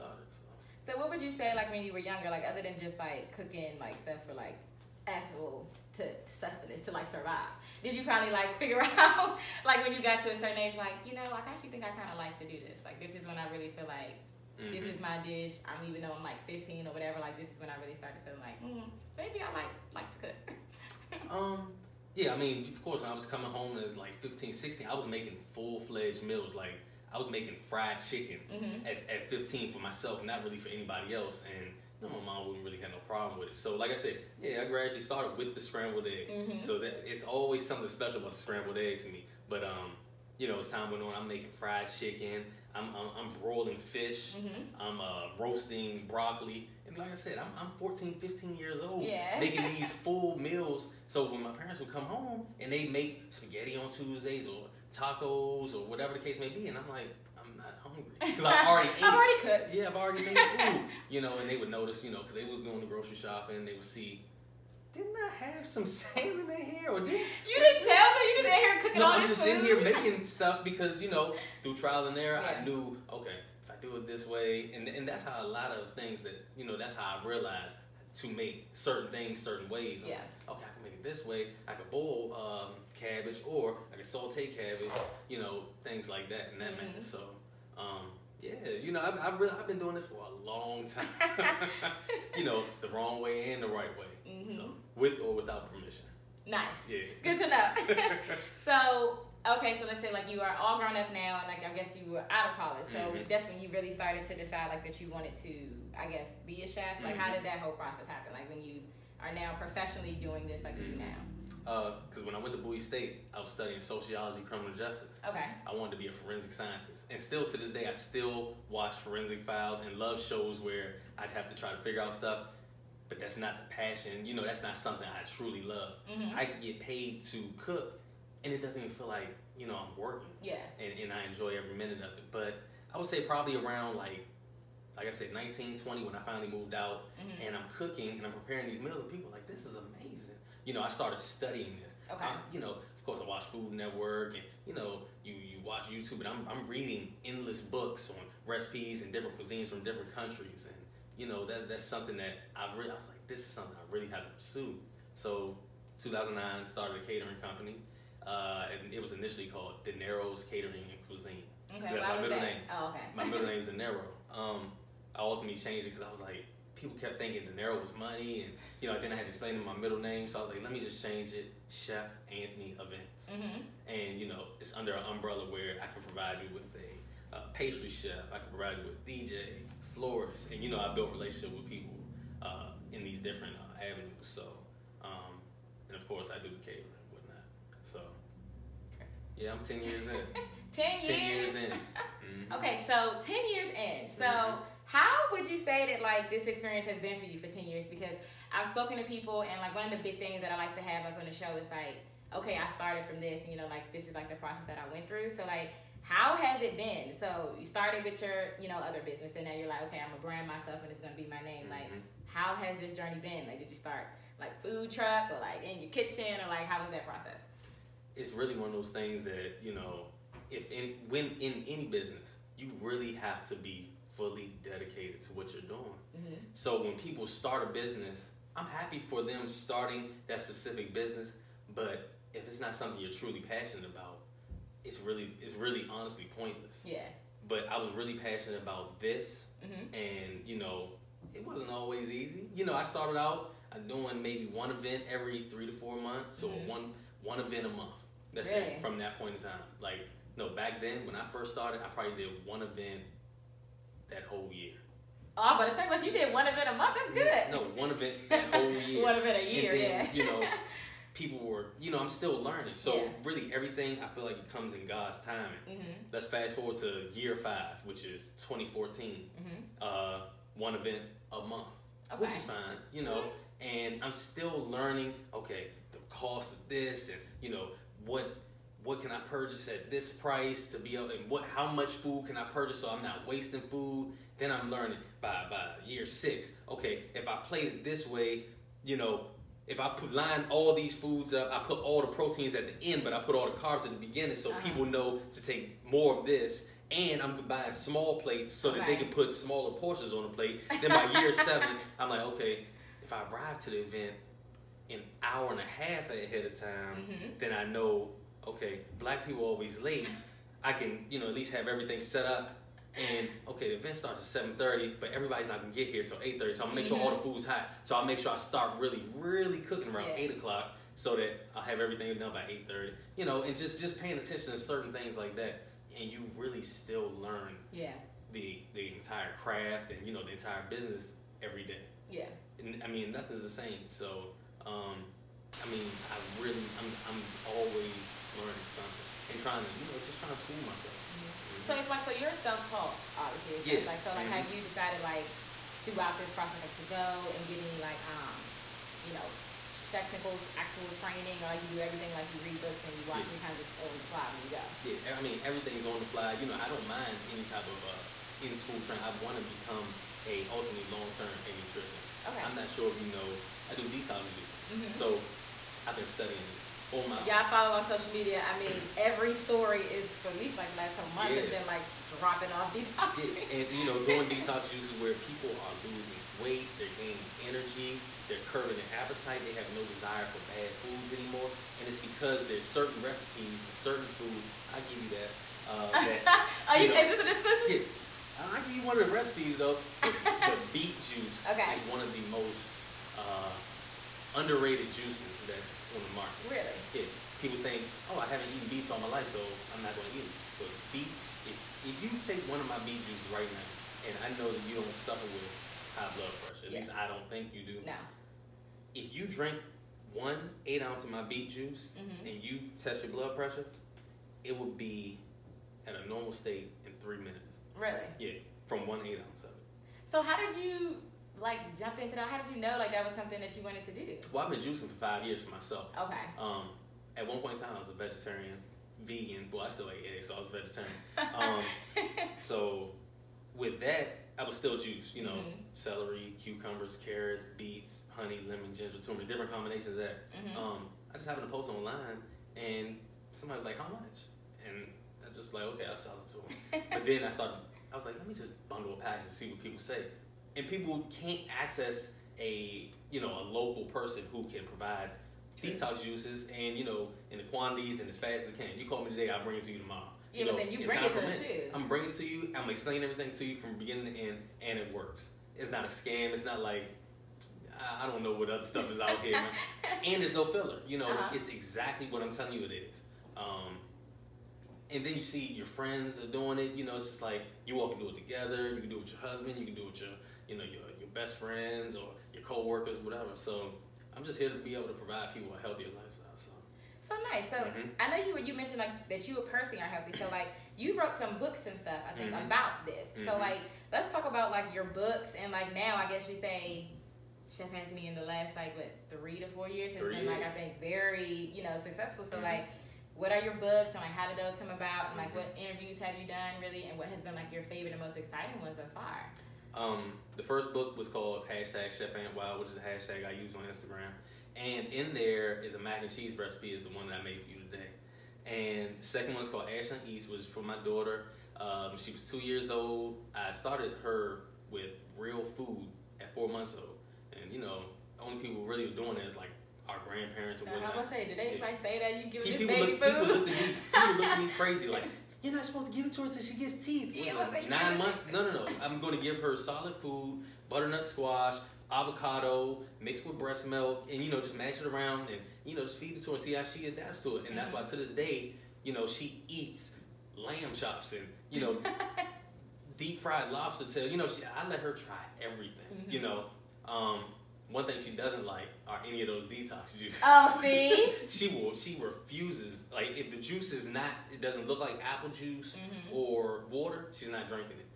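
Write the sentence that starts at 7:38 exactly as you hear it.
You call me today, I'll bring it to you tomorrow.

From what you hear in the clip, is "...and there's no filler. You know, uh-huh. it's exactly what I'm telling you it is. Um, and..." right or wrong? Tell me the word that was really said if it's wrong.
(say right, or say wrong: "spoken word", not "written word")
right.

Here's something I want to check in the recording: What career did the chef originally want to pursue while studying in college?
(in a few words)
forensic scientist.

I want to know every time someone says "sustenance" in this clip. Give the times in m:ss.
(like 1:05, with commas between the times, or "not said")
0:06.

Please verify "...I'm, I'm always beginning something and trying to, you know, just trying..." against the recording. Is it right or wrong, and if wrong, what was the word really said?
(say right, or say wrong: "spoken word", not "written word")
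wrong: "learning", not "beginning".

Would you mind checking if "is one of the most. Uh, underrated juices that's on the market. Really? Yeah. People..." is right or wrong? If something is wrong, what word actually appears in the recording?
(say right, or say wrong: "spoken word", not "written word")
right.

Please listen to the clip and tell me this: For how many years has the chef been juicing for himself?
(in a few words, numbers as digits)
5.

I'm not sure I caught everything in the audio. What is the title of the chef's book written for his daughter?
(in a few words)
Ashton East.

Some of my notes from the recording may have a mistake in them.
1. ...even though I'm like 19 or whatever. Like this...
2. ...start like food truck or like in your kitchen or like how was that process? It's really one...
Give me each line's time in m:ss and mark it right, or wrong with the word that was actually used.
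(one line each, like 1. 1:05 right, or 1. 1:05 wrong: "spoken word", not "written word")
1. 0:15 wrong: "15", not "19"
2. 3:33 right.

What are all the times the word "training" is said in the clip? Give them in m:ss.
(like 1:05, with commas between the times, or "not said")
5:50, 5:58.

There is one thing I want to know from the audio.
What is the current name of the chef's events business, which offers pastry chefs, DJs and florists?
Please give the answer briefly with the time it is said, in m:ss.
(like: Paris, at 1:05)
Chef Anthony Events, at 2:51.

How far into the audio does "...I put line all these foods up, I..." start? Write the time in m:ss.
4:49.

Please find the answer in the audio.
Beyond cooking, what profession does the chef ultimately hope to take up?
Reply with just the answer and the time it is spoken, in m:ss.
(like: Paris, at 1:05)
nutritionist, at 6:01.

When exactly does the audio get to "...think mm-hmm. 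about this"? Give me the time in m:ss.
8:12.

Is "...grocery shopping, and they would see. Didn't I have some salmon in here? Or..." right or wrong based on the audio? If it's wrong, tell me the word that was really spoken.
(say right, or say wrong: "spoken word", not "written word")
right.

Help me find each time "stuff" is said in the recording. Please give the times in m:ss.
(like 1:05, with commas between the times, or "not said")
0:03, 1:10, 2:02, 7:48, 8:11.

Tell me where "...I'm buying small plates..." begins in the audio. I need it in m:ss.
4:57.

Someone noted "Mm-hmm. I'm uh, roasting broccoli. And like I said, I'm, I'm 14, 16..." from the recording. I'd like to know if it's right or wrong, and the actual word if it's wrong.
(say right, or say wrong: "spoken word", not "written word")
wrong: "15", not "16".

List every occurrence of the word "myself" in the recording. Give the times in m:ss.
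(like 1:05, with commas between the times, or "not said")
0:29, 3:30, 5:40, 7:05.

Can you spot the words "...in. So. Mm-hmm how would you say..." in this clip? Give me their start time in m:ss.
3:13.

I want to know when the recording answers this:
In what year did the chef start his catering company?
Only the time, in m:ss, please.
2:35.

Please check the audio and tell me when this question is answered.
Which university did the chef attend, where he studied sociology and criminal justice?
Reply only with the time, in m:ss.
1:52.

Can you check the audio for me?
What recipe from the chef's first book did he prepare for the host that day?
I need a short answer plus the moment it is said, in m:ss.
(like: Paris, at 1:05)
mac and cheese, at 8:35.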